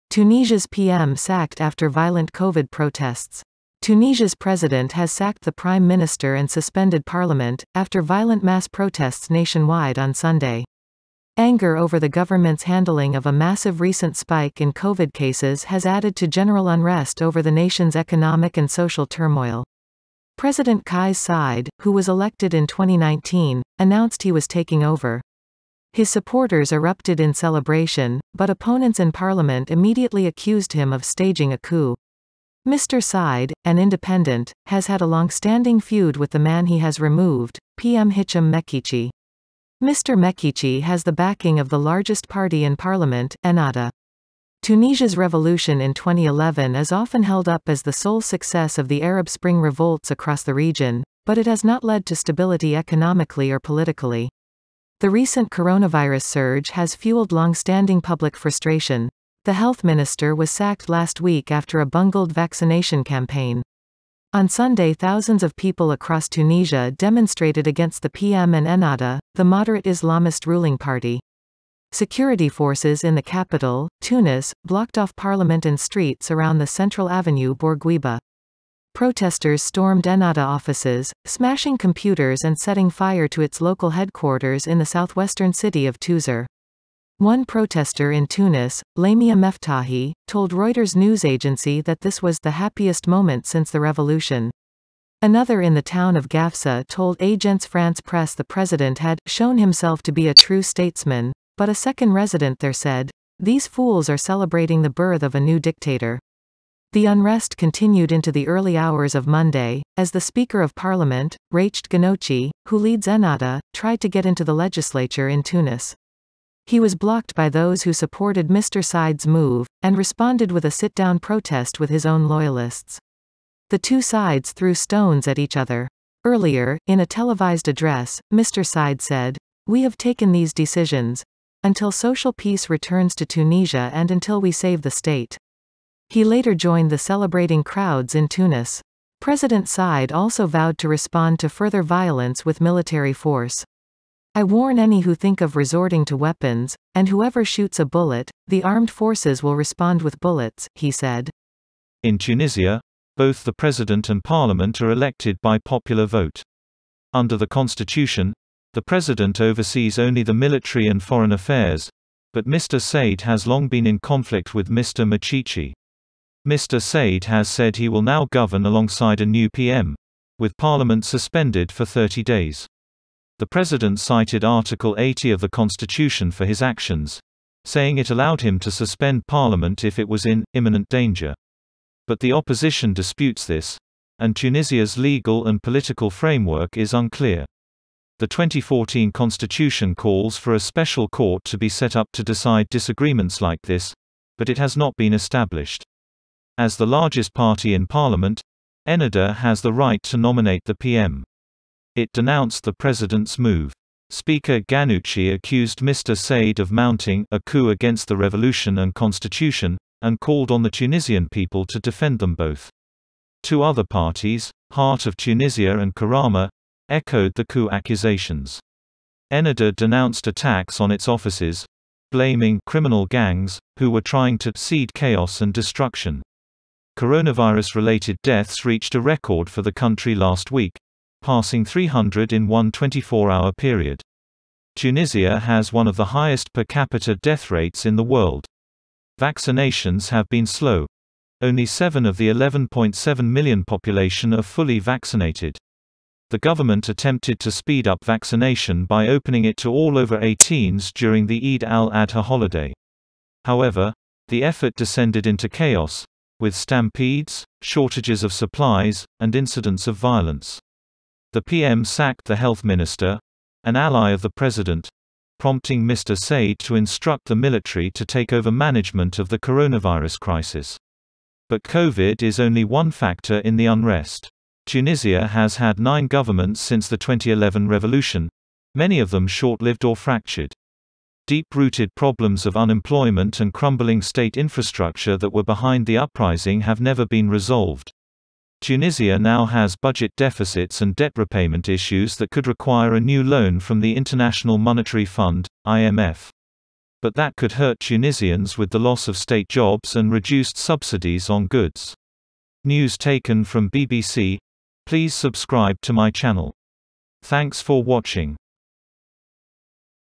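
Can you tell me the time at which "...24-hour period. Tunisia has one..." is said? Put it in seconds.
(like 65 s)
232 s.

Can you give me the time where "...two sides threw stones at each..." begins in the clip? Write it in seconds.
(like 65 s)
123 s.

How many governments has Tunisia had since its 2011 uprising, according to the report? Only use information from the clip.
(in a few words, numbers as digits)
9.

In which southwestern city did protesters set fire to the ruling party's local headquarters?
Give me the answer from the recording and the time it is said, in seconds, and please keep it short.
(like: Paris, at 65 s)
Touzeur, at 85 s.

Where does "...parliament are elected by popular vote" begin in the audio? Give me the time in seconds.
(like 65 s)
154 s.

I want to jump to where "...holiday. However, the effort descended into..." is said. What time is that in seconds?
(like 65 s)
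252 s.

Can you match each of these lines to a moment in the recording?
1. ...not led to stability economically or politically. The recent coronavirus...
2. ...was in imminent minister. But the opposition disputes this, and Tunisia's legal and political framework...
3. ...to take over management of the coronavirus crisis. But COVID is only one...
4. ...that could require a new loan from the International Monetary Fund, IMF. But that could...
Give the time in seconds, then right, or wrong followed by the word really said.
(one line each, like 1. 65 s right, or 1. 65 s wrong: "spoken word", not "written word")
1. 51 s right
2. 180 s wrong: "danger", not "minister"
3. 267 s right
4. 292 s right.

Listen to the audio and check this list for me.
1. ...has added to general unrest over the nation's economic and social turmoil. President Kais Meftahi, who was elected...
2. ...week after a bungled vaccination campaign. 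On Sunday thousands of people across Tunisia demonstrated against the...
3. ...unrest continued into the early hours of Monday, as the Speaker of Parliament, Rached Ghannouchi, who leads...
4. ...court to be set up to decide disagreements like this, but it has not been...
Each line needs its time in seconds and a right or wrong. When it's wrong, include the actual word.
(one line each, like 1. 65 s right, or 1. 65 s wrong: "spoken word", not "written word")
1. 15 s wrong: "Saied", not "Meftahi"
2. 61 s right
3. 107 s right
4. 191 s right.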